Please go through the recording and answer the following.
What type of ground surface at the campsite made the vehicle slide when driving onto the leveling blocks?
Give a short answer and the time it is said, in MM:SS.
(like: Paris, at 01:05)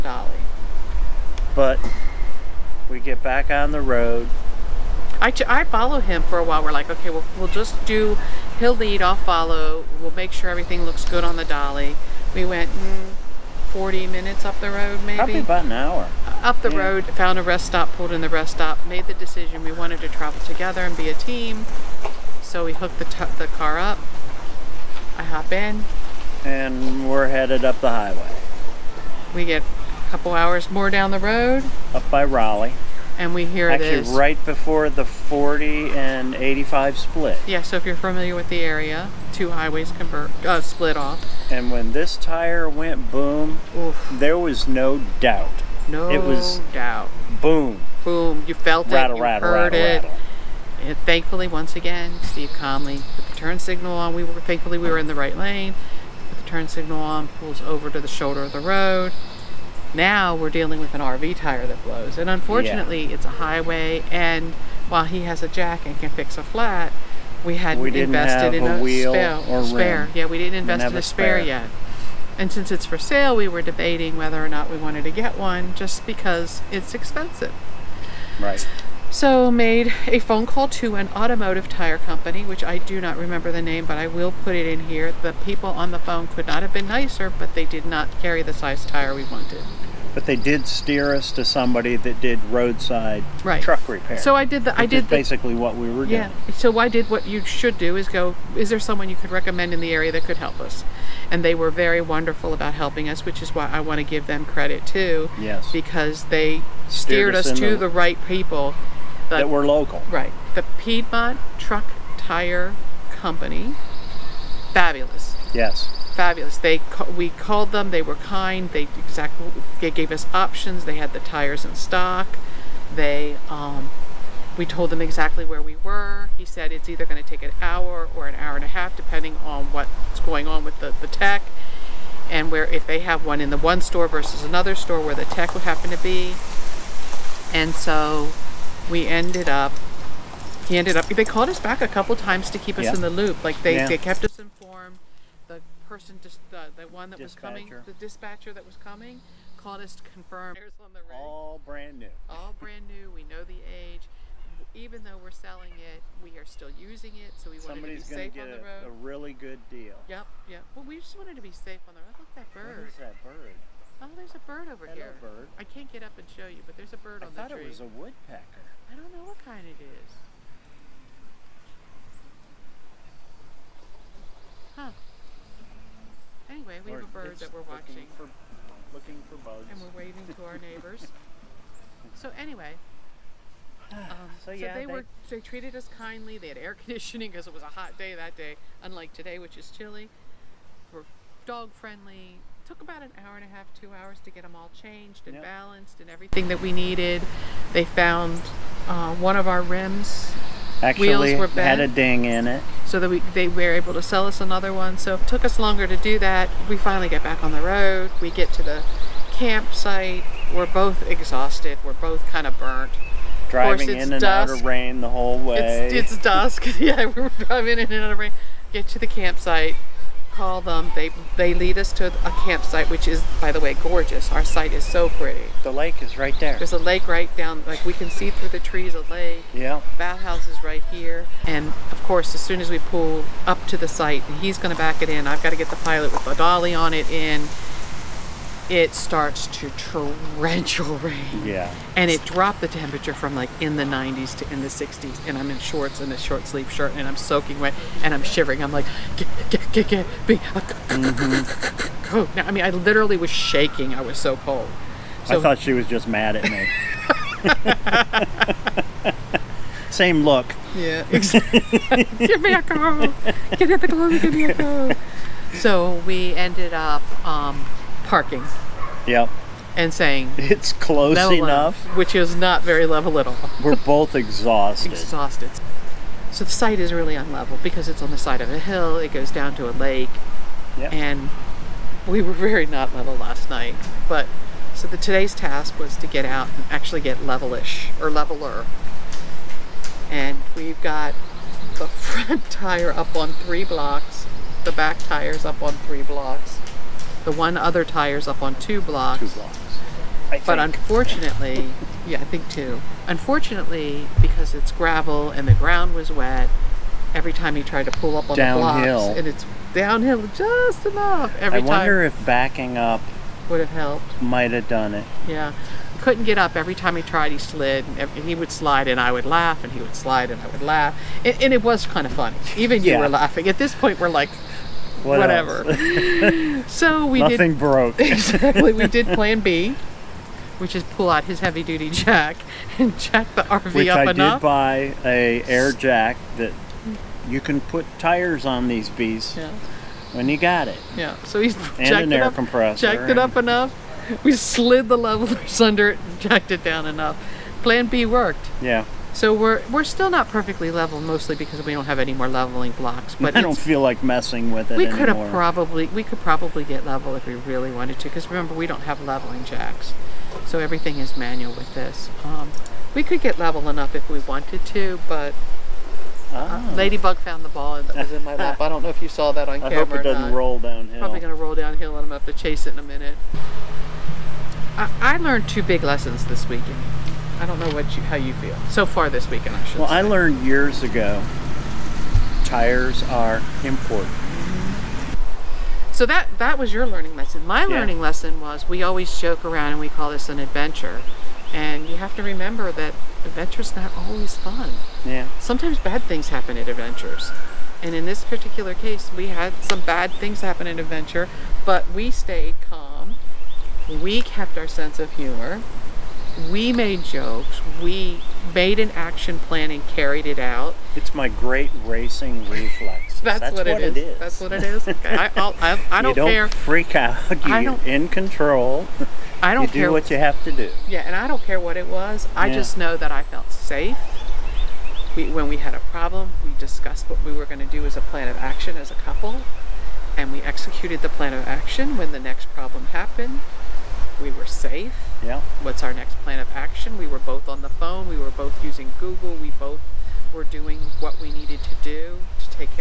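gravel, at 05:04.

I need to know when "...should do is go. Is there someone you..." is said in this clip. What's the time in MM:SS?
01:37.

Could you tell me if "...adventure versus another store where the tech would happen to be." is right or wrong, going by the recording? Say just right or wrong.
wrong.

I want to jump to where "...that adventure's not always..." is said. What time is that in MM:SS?
06:32.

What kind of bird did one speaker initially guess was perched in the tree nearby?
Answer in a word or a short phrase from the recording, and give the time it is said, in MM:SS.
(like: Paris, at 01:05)
woodpecker, at 02:47.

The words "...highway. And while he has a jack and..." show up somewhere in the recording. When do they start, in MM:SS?
01:03.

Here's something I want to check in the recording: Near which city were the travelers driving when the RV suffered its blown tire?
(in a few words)
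Raleigh.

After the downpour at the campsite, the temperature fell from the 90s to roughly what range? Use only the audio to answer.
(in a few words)
the 60s.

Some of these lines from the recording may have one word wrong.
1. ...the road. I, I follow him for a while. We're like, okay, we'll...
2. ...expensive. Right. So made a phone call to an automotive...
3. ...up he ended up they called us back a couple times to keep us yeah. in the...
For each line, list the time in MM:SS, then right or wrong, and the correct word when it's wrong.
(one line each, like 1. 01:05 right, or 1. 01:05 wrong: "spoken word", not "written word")
1. 00:03 right
2. 01:16 right
3. 02:19 right.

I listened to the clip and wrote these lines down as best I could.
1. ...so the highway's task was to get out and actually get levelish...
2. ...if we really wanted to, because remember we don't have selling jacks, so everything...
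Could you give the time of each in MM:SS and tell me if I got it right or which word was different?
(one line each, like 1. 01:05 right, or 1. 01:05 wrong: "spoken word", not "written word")
1. 04:44 wrong: "today", not "highway"
2. 05:57 wrong: "leveling", not "selling".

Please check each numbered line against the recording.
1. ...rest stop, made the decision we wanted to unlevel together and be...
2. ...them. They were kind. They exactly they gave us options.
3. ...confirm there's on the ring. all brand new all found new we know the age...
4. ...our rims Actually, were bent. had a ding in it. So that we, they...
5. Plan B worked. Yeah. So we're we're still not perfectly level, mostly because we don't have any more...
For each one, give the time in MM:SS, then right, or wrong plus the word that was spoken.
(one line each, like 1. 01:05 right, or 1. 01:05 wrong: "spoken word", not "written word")
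1. 00:18 wrong: "travel", not "unlevel"
2. 01:57 right
3. 02:30 wrong: "brand", not "found"
4. 03:19 right
5. 05:47 right.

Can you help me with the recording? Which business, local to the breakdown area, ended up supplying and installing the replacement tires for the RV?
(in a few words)
Piedmont Truck Tire Company.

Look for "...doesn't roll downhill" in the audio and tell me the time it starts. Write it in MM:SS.
06:10.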